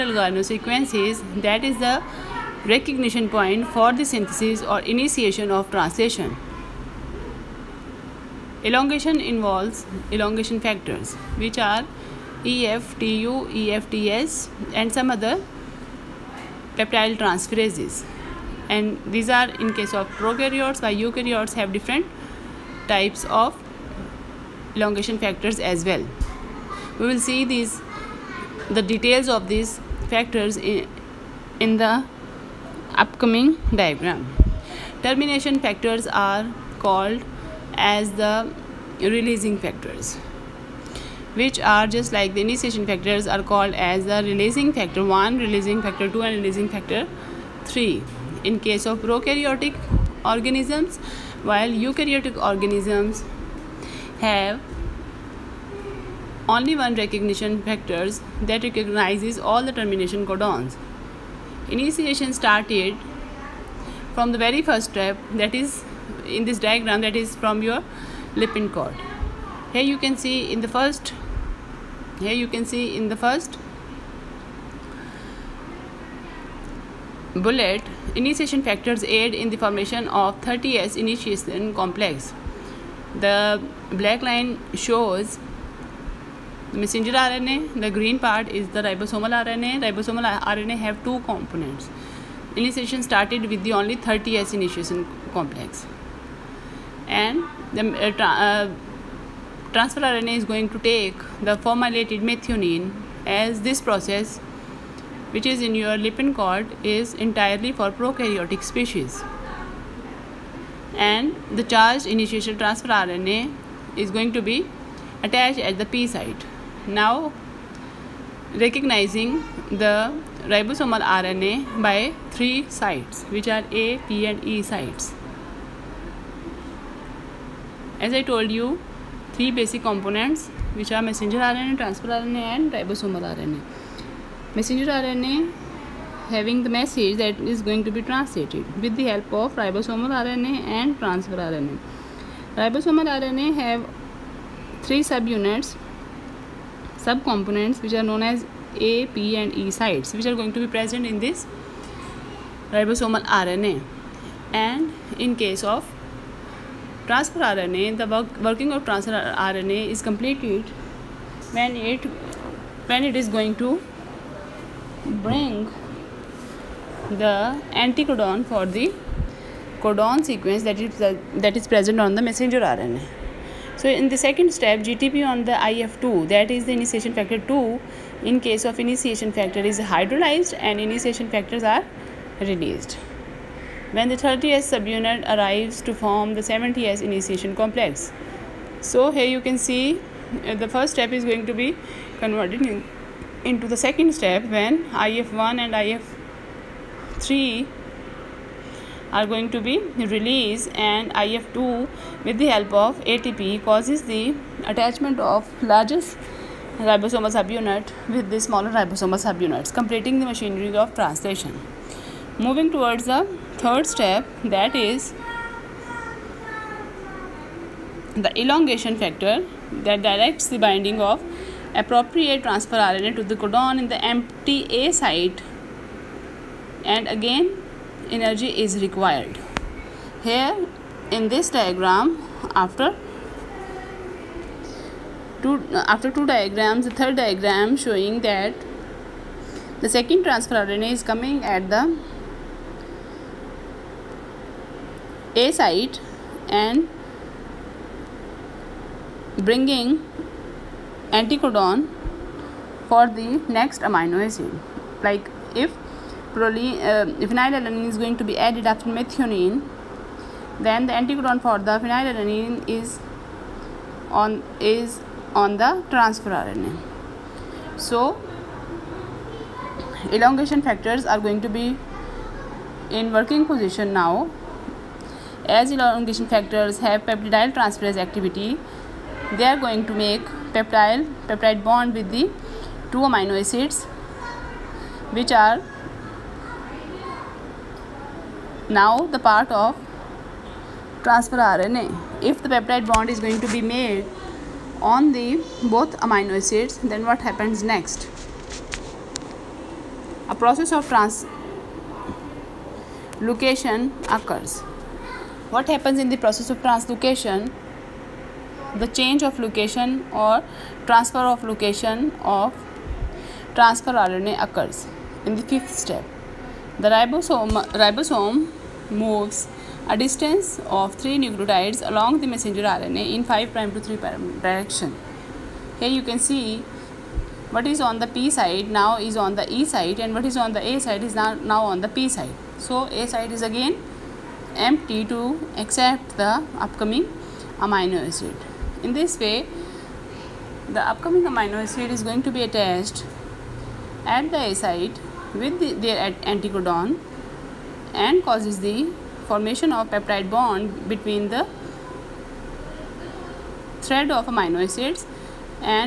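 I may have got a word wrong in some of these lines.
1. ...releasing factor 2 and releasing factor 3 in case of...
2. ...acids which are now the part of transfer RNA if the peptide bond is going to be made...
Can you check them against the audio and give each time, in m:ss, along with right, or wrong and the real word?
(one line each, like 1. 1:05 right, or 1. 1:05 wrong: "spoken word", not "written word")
1. 0:45 right
2. 4:43 right.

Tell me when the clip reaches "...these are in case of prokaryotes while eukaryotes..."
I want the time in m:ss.
0:19.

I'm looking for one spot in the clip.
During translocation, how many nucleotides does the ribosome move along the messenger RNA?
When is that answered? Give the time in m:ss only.
5:21.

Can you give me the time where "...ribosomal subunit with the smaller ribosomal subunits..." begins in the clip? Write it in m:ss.
3:26.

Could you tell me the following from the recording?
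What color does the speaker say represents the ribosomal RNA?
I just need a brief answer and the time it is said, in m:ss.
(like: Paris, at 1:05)
Green, at 1:27.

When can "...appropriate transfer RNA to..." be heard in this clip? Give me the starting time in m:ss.
3:41.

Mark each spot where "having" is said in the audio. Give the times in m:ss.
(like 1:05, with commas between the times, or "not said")
2:16.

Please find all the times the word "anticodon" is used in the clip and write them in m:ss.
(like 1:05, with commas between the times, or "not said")
2:47, 4:11, 4:20, 5:46.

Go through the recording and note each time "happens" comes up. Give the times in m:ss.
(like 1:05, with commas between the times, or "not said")
4:57, 5:05.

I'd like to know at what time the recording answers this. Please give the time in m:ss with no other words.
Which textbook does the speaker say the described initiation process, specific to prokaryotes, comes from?
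1:46.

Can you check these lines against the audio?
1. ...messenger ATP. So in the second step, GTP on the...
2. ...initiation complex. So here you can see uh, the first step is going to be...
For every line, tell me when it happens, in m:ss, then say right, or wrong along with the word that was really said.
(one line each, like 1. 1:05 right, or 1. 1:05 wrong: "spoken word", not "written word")
1. 2:52 wrong: "RNA", not "ATP"
2. 3:07 right.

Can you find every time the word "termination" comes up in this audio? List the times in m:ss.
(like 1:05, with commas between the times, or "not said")
0:35, 0:59.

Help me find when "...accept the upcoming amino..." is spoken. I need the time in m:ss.
5:35.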